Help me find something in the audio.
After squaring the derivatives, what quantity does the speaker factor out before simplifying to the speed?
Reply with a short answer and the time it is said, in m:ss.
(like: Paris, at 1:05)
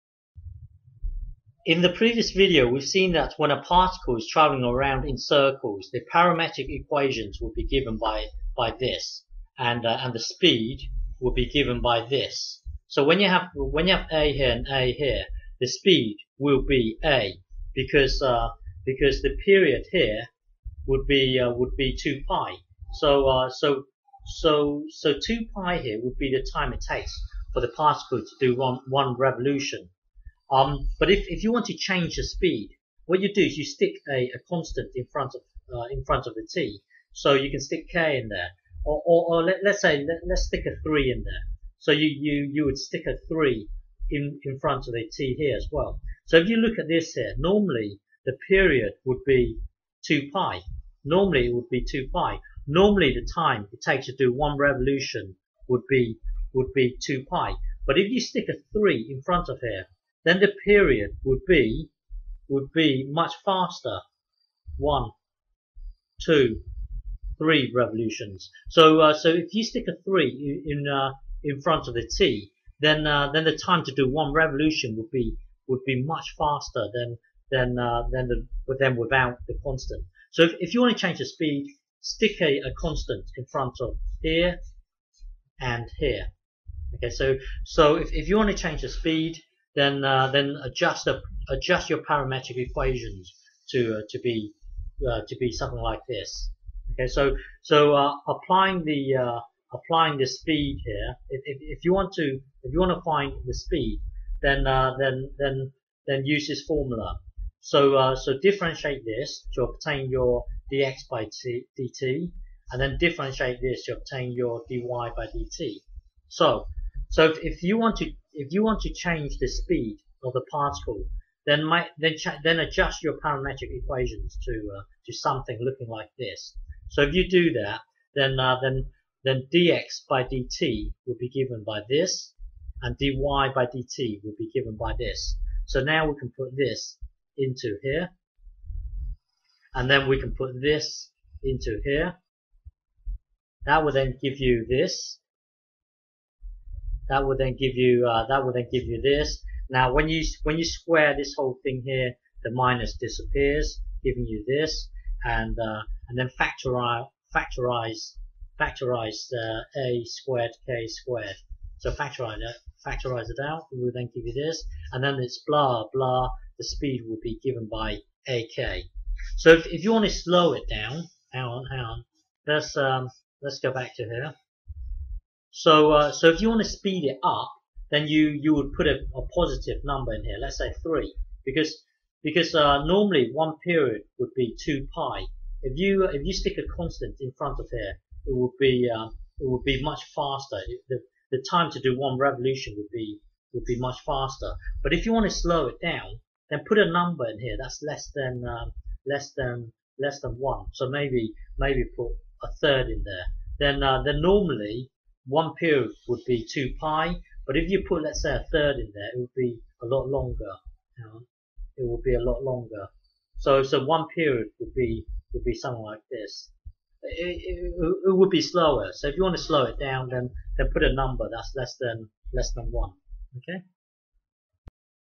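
a squared k squared, at 2:39.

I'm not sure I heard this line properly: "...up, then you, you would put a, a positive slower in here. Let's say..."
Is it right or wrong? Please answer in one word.
wrong.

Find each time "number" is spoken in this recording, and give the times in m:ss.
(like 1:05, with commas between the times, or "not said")
2:59, 3:16, 3:40.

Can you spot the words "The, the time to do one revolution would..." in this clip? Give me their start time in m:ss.
3:10.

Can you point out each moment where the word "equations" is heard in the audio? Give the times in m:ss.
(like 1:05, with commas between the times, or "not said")
0:06, 1:32, 2:03.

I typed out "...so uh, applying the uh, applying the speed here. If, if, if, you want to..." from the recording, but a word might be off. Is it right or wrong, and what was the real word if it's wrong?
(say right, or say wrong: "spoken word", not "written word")
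right.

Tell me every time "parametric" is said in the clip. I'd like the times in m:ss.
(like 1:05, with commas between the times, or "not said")
0:06, 1:31, 2:03.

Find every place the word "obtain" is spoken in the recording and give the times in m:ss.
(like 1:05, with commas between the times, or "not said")
1:49, 1:53.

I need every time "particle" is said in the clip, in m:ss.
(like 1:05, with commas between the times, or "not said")
0:03, 0:27, 2:00.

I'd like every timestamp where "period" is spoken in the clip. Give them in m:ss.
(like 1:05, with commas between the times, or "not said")
0:19, 0:48, 1:00, 3:03, 3:25, 3:34.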